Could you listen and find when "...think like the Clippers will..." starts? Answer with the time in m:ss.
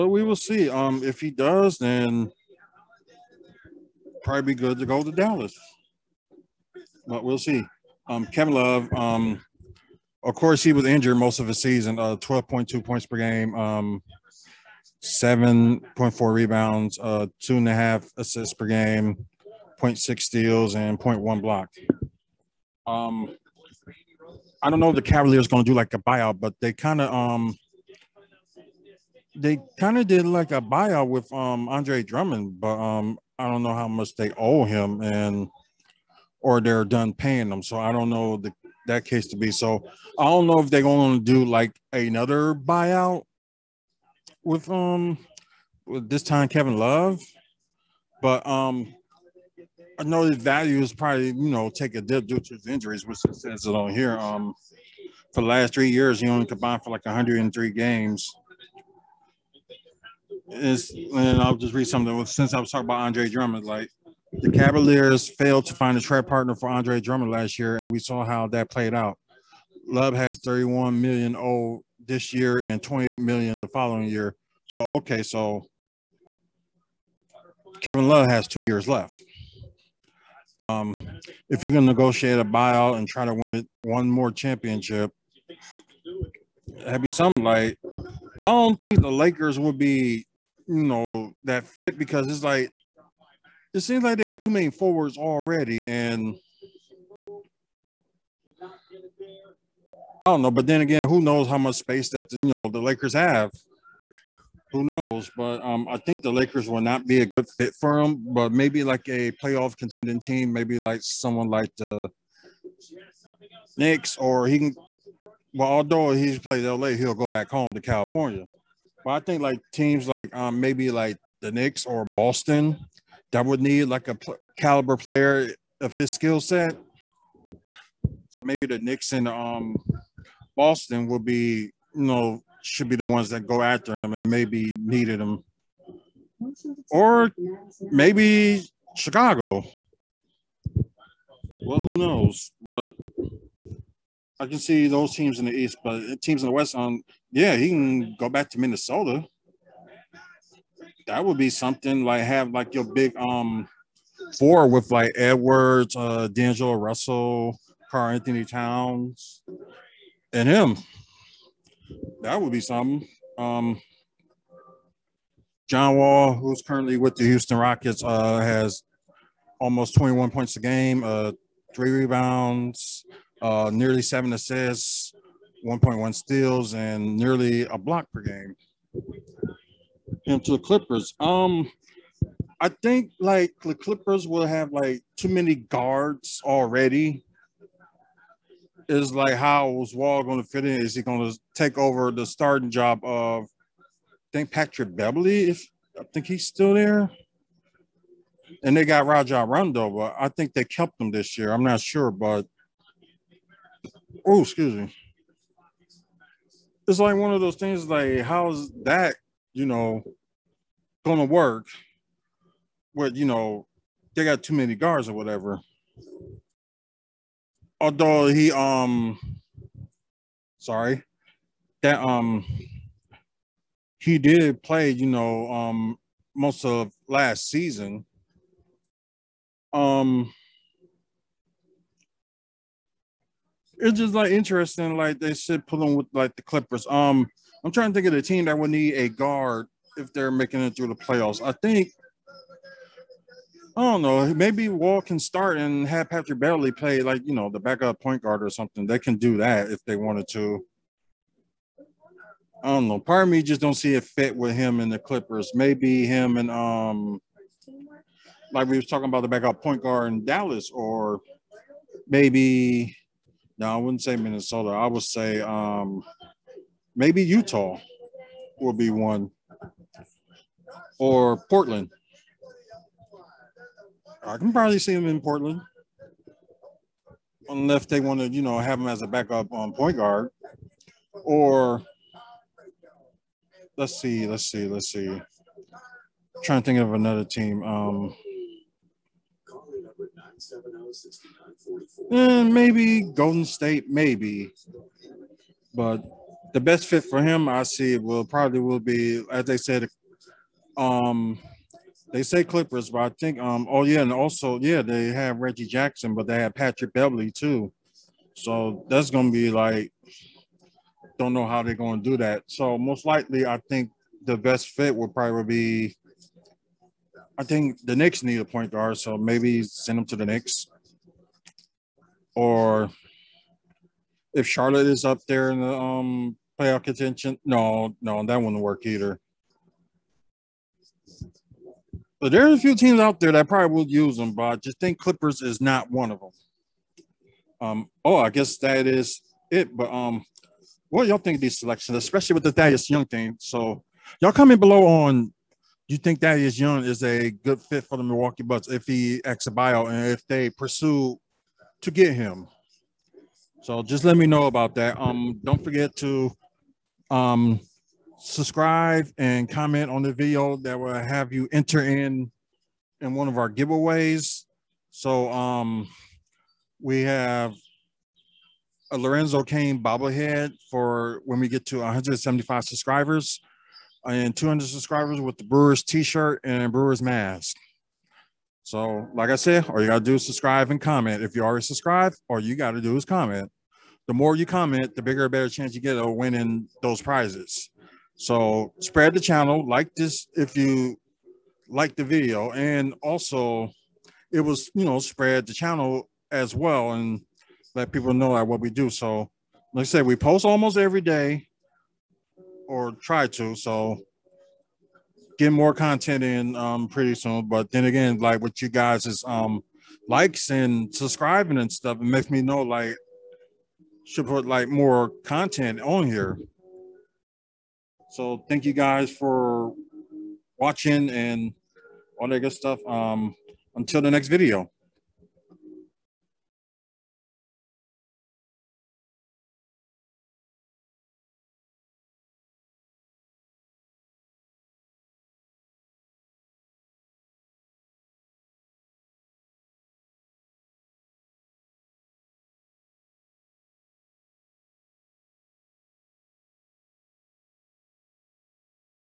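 3:02.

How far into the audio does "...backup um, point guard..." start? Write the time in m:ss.
4:39.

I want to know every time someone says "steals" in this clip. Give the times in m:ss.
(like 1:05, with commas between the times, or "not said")
0:20, 2:56.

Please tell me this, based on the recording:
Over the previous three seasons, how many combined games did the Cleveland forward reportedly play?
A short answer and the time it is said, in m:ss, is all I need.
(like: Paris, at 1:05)
103, at 0:57.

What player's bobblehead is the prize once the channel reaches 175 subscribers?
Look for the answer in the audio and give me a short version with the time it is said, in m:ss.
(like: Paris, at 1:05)
Lorenzo Cain, at 6:08.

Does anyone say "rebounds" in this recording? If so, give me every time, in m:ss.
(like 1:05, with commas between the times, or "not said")
0:16, 2:51.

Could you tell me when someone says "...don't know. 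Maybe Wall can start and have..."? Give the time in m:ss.
4:03.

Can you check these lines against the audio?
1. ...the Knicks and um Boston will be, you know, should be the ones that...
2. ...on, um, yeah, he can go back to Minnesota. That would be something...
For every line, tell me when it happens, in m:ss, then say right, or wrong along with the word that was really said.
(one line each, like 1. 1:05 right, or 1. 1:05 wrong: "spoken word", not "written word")
1. 2:08 right
2. 2:26 right.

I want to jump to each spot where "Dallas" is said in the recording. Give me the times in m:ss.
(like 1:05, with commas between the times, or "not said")
0:05, 4:20.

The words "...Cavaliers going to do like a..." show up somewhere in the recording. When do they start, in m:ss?
0:25.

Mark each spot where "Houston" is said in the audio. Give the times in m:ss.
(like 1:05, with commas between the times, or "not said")
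2:47.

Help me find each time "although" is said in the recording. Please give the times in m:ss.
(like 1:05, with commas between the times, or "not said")
1:55, 3:37.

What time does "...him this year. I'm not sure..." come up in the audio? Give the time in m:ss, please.
3:20.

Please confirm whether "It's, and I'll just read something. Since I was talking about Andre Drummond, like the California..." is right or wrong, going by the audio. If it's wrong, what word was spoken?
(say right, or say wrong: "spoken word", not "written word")
wrong: "Cavaliers", not "California".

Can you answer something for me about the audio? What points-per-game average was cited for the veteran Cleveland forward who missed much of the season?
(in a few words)
12.2.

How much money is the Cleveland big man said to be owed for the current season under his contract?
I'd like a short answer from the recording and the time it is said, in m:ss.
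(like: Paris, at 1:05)
31 million, at 1:10.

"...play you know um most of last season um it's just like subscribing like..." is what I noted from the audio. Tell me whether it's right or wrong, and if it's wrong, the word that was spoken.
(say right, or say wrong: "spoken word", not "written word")
wrong: "interesting", not "subscribing".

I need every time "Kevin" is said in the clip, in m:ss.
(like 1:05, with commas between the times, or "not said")
0:08, 0:46, 1:17.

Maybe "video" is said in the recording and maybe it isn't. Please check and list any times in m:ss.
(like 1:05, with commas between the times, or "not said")
6:00, 6:32, 7:04.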